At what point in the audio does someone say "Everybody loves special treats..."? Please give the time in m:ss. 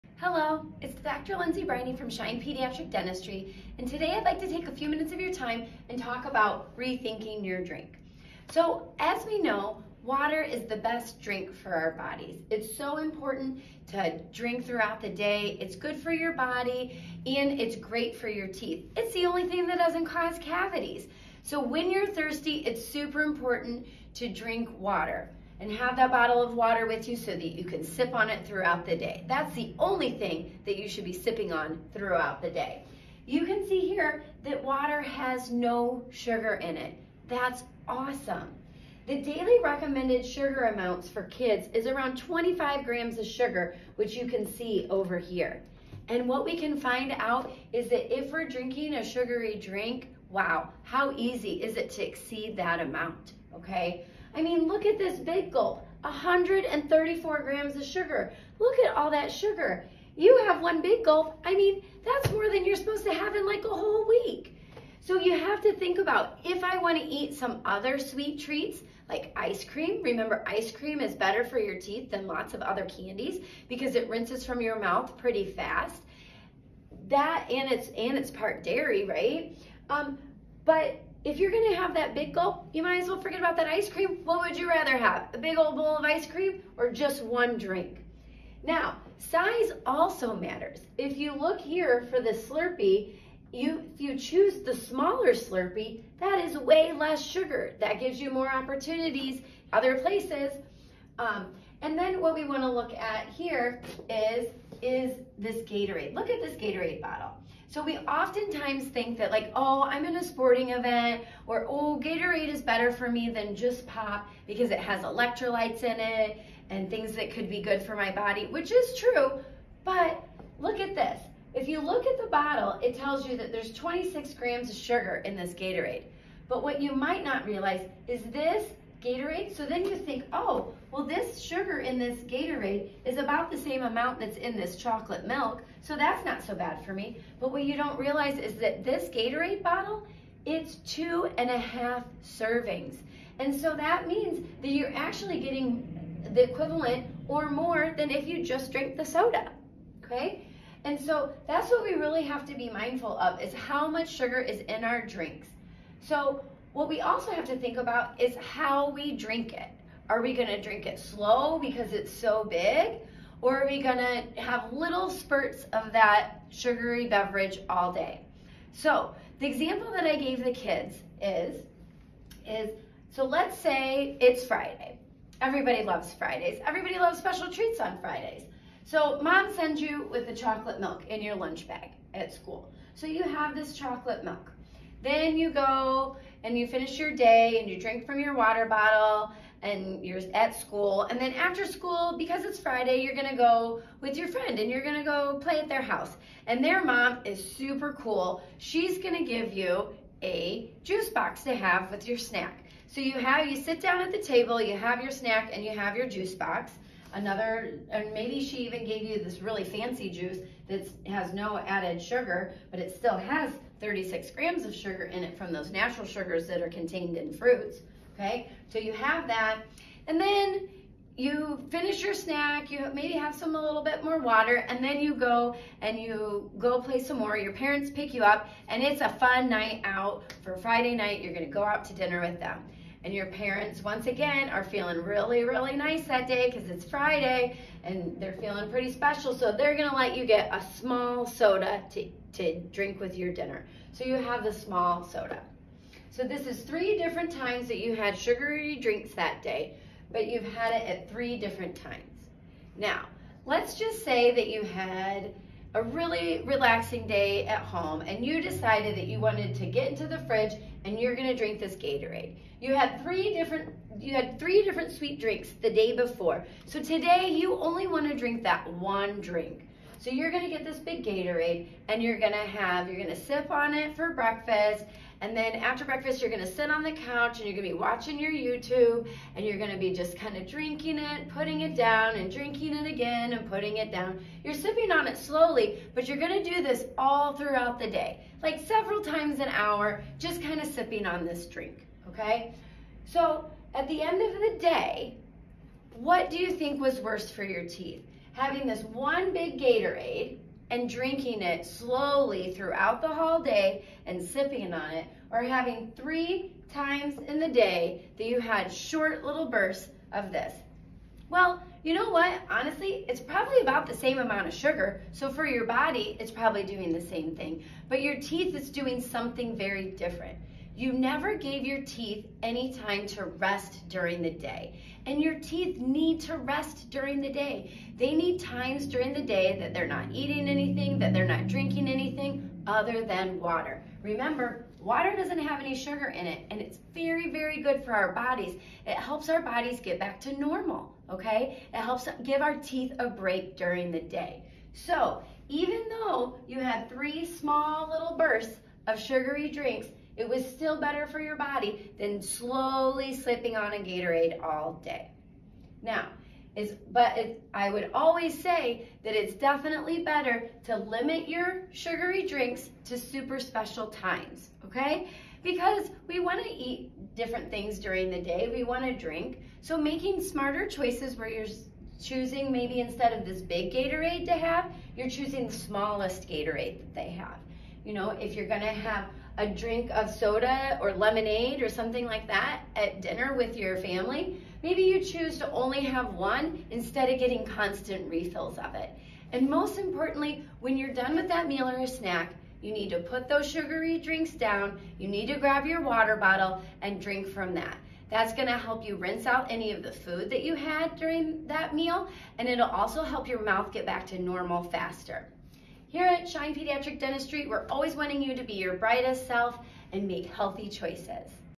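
2:56.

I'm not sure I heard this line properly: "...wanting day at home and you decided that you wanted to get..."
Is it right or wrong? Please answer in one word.
wrong.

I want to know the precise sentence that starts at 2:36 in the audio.
So what we also have to think about is how we drink it.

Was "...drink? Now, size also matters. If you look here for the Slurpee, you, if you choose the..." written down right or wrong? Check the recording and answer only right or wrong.
right.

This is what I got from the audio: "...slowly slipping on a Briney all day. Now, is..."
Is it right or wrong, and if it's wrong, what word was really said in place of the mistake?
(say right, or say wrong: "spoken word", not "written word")
wrong: "Gatorade", not "Briney".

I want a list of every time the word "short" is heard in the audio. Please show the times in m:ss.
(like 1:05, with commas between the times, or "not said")
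5:08.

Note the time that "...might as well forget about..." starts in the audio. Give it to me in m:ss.
1:22.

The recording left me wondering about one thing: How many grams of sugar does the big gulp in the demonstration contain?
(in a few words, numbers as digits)
134 grams.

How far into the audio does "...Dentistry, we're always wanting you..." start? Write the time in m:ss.
6:47.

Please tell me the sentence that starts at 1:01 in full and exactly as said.
I mean, that's more than you're supposed to have in like a whole week.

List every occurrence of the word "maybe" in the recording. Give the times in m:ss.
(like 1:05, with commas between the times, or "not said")
3:28, 3:42, 6:12, 6:24.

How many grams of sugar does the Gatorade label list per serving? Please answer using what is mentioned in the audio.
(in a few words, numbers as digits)
26 grams.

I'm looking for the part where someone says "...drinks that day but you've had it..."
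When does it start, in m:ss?
4:08.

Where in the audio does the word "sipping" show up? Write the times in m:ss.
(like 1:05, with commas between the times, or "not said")
0:31, 4:44, 4:50, 5:04.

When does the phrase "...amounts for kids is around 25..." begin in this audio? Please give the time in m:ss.
0:40.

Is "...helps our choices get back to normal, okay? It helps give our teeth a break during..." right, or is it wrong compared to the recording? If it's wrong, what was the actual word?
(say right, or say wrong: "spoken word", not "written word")
wrong: "bodies", not "choices".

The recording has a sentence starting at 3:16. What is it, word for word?
And their mom is super cool.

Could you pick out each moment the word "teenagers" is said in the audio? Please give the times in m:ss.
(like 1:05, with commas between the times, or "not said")
not said.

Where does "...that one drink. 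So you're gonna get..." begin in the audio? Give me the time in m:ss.
4:28.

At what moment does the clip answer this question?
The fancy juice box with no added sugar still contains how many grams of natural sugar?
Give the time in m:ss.
3:33.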